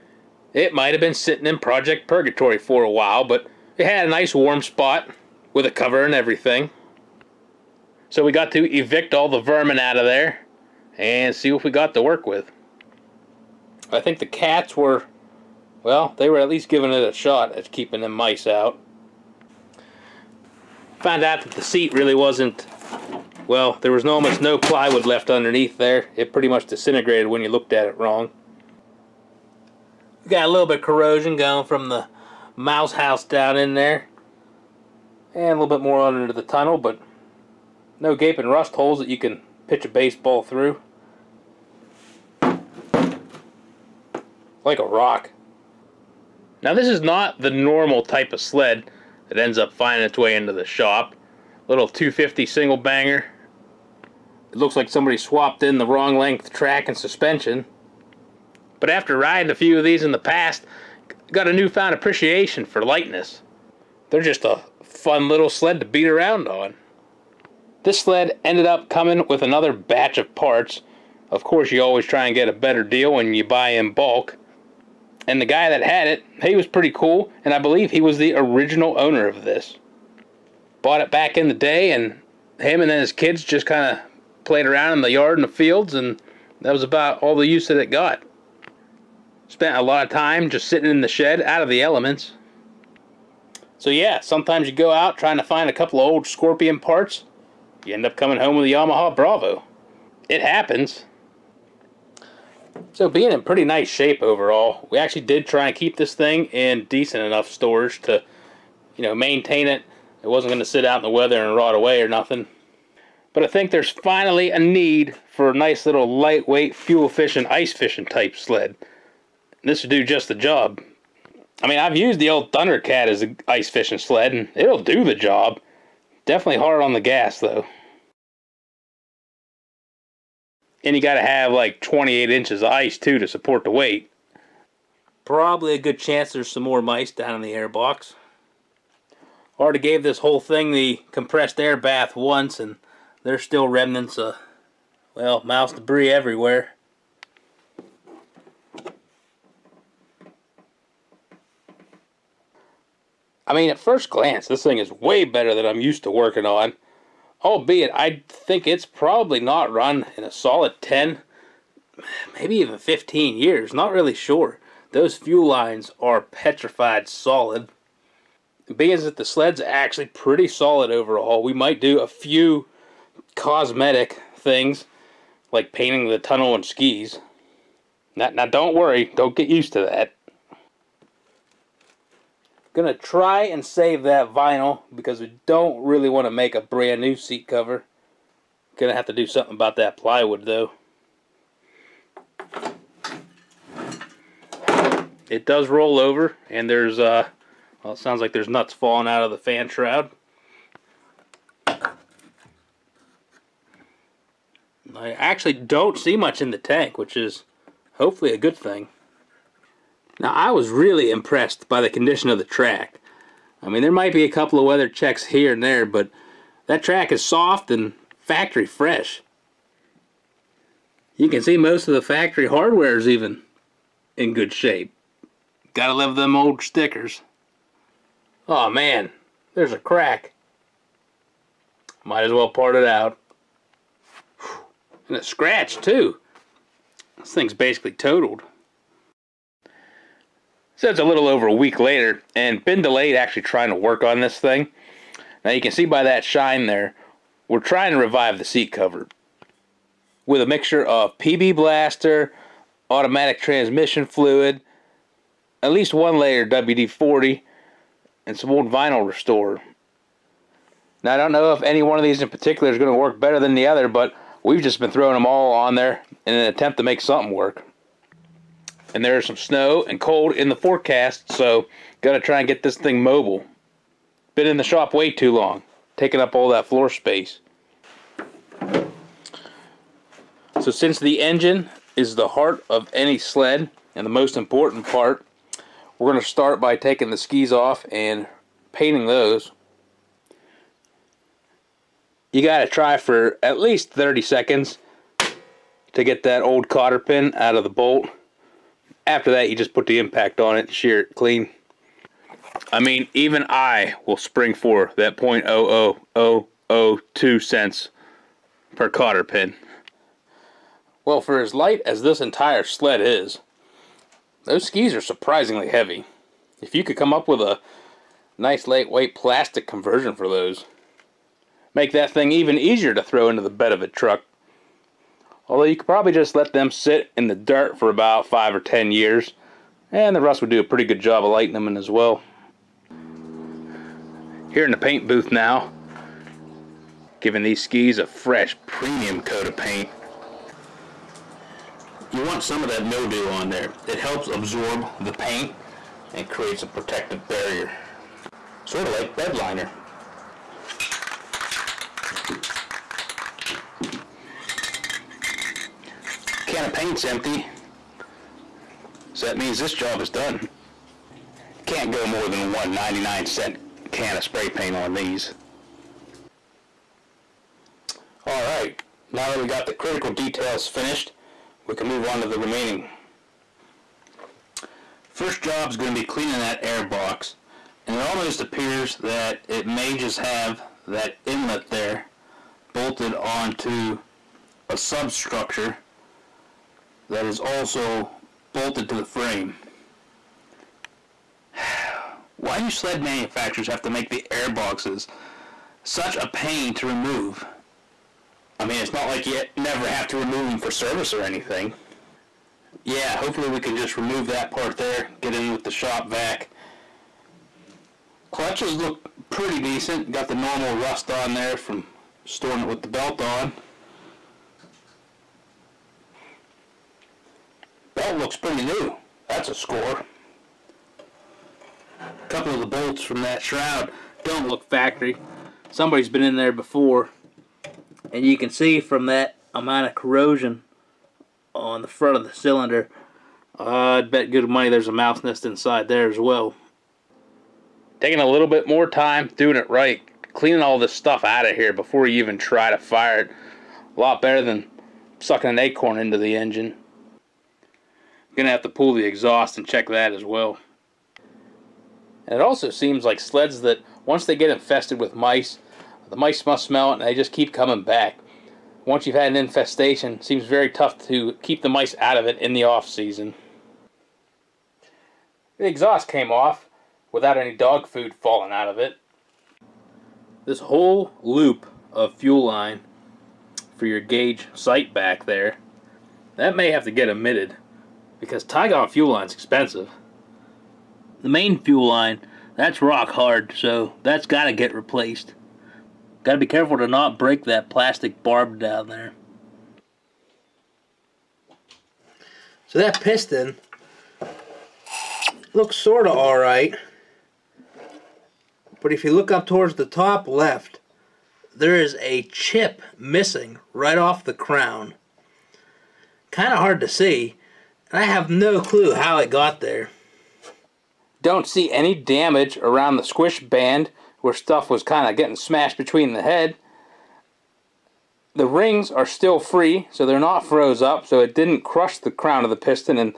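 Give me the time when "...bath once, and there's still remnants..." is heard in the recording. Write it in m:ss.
2:21.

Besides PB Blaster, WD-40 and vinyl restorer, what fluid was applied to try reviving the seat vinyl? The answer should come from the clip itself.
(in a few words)
automatic transmission fluid.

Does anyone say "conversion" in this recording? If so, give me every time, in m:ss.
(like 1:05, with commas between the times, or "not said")
5:19.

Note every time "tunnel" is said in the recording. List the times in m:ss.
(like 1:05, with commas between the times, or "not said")
0:36, 2:56.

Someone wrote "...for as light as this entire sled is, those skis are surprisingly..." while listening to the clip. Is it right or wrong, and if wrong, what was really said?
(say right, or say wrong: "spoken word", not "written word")
right.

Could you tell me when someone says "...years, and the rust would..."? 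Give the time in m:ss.
5:28.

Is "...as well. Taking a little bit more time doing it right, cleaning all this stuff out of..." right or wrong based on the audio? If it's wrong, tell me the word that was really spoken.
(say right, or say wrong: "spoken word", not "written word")
right.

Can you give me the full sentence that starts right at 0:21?
Found out that the seat really wasn't, well, there was almost no plywood left underneath there.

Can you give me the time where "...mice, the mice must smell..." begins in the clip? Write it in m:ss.
7:35.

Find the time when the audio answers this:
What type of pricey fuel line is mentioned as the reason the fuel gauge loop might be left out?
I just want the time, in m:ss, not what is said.
7:58.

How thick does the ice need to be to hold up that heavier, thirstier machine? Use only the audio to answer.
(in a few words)
28 inches.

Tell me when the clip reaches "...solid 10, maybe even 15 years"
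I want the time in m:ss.
2:40.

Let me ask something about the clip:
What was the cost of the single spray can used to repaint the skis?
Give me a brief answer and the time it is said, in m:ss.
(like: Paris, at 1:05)
99 cents, at 6:02.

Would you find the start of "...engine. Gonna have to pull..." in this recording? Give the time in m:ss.
7:26.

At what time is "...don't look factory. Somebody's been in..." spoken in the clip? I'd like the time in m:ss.
7:04.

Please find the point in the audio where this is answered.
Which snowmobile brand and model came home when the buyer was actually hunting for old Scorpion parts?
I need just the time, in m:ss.
1:38.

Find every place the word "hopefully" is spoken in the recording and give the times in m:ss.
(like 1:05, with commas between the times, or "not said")
3:27, 6:43.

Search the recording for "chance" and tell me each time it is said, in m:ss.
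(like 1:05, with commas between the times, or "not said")
2:15.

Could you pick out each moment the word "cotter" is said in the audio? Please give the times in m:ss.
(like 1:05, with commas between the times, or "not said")
4:56, 5:08.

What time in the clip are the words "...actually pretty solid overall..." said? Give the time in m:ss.
2:49.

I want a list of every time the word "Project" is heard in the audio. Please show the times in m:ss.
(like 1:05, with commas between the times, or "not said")
0:01.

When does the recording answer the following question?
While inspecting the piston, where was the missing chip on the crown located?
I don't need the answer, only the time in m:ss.
8:19.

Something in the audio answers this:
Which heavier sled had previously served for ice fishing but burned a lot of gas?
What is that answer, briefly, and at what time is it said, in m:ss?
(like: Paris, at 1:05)
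Thundercat, at 2:02.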